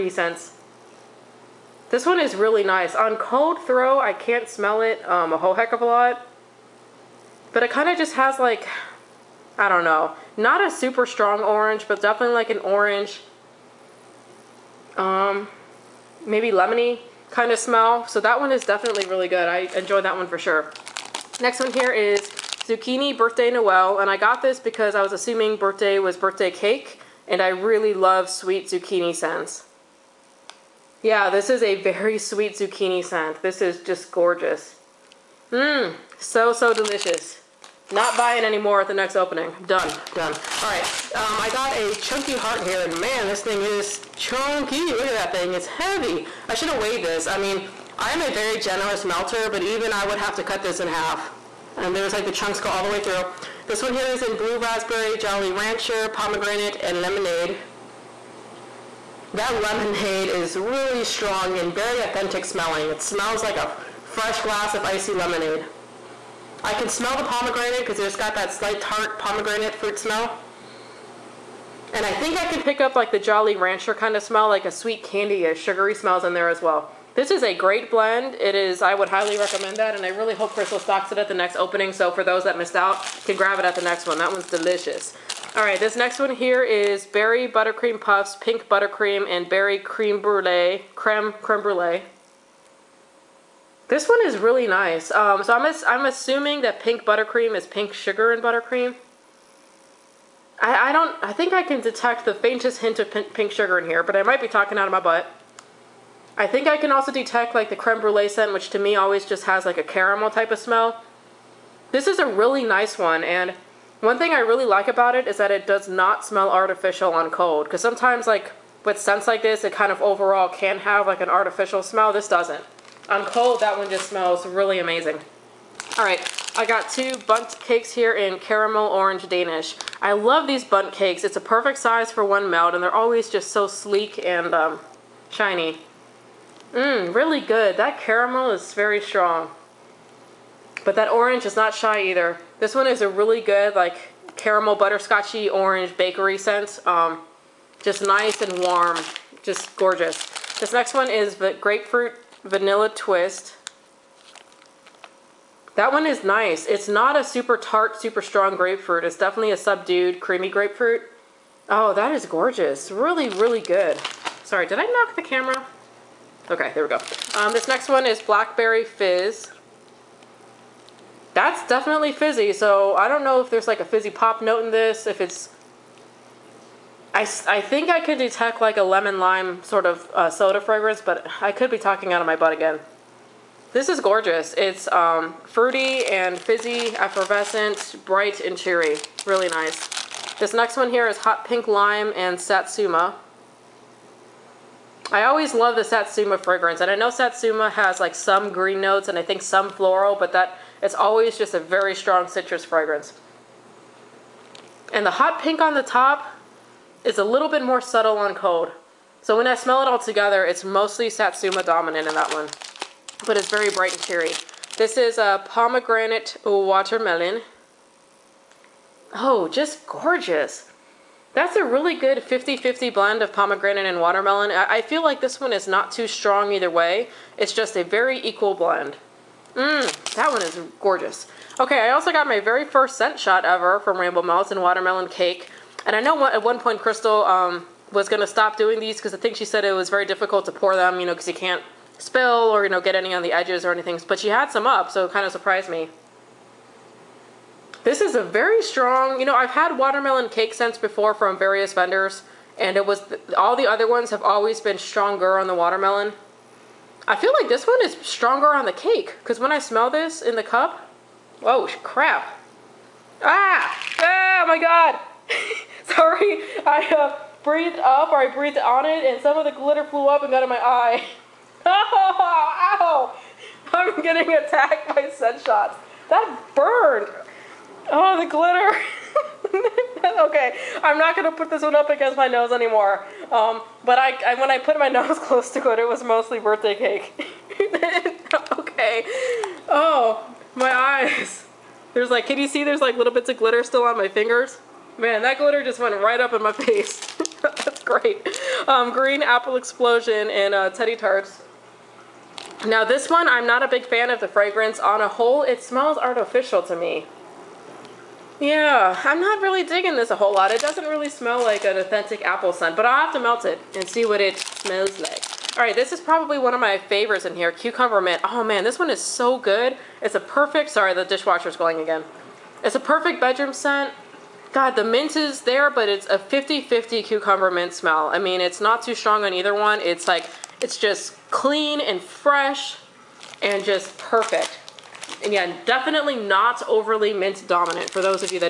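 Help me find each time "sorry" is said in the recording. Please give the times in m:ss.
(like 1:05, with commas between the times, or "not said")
2:44, 4:25, 5:20.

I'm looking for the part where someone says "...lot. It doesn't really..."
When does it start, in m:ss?
5:10.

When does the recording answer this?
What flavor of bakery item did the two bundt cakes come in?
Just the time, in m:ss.
2:08.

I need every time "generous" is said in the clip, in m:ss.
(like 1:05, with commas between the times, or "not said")
0:48.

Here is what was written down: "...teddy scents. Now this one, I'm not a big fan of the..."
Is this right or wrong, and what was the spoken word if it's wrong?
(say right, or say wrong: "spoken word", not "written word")
wrong: "tarts", not "scents".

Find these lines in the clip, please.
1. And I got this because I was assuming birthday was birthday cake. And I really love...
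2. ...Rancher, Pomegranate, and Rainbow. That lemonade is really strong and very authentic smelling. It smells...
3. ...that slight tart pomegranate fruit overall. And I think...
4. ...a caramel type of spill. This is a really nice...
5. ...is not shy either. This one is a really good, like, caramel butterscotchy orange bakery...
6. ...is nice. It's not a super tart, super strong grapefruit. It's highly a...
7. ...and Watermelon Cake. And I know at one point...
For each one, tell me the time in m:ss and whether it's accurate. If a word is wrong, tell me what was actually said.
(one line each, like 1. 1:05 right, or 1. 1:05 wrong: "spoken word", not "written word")
1. 0:23 right
2. 0:55 wrong: "Lemonade", not "Rainbow"
3. 1:08 wrong: "smell", not "overall"
4. 1:49 wrong: "smell", not "spill"
5. 2:21 right
6. 2:36 wrong: "definitely", not "highly"
7. 3:54 right.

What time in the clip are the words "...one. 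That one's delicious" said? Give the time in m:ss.
1:24.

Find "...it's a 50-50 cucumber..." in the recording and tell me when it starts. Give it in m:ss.
5:25.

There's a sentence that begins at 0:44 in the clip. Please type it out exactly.
Look at that thing, it's heavy.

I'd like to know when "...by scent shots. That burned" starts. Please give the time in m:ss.
4:34.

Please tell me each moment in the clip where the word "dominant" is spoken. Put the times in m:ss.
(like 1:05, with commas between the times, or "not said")
3:31, 5:37.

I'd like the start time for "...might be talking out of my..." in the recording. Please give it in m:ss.
1:44.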